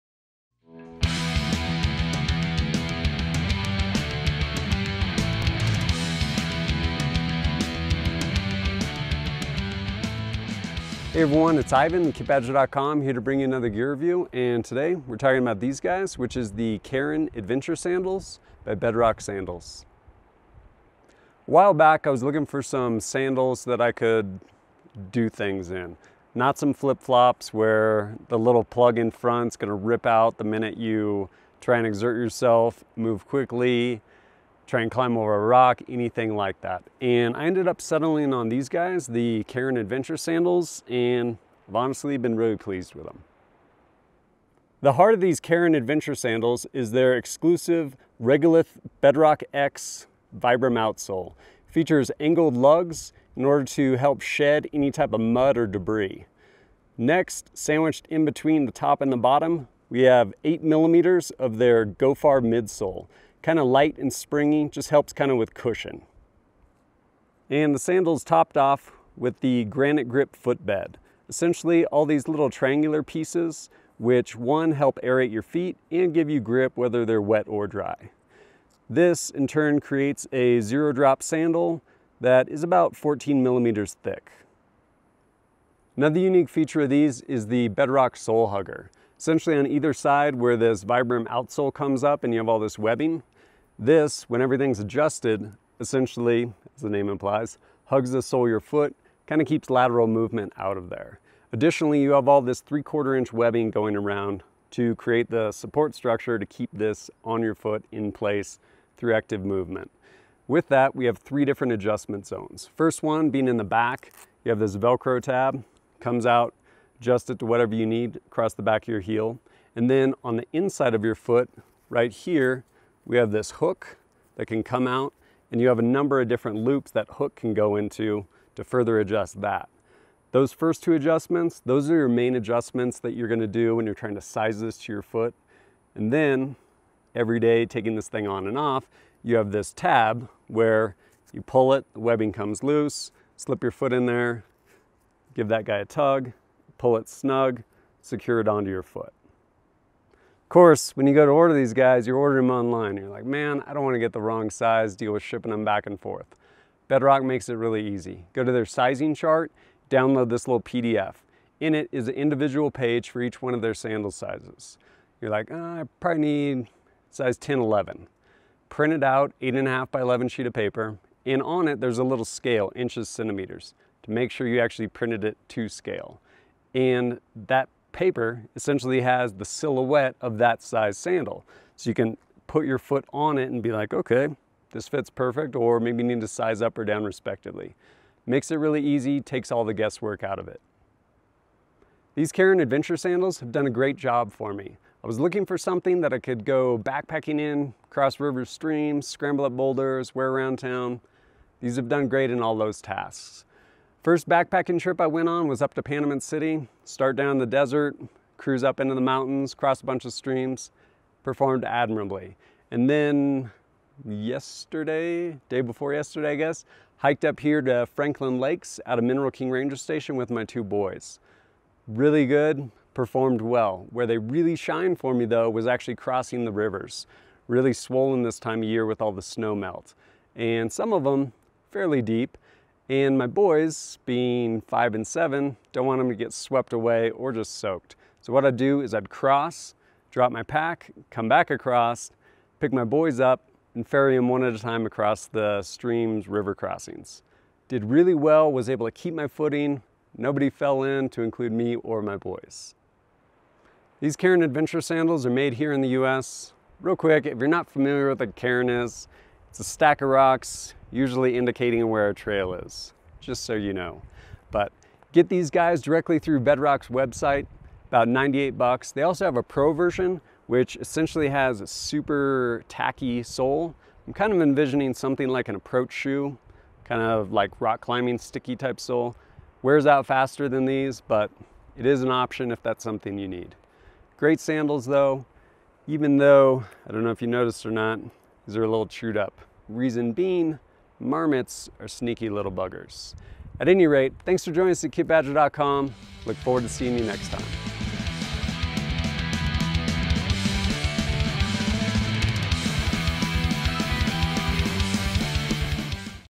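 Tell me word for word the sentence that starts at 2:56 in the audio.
And that paper essentially has the silhouette of that size sandal.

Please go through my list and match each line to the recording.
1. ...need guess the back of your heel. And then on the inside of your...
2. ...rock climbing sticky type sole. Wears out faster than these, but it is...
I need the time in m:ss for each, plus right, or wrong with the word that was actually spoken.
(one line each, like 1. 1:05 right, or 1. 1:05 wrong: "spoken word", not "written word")
1. 1:57 wrong: "across", not "guess"
2. 4:37 right.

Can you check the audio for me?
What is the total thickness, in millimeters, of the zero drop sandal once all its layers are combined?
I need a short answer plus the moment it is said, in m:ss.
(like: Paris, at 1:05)
14 millimeters, at 1:22.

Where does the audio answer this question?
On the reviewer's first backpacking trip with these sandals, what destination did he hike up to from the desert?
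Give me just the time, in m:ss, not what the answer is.
3:25.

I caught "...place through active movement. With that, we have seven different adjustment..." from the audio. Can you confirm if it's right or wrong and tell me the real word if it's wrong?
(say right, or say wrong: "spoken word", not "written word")
wrong: "three", not "seven".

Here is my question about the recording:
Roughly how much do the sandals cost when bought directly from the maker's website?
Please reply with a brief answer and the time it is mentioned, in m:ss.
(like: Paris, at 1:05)
$98, at 4:28.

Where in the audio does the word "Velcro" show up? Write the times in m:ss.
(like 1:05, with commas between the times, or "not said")
1:54.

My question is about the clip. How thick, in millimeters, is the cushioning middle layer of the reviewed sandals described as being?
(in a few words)
8 millimeters.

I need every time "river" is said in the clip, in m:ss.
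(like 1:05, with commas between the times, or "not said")
3:18, 3:46, 4:06.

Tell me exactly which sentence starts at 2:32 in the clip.
You're like, man, I don't want to get the wrong size, deal with shipping them back and forth.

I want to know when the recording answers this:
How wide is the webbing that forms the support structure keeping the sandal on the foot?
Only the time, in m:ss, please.
1:42.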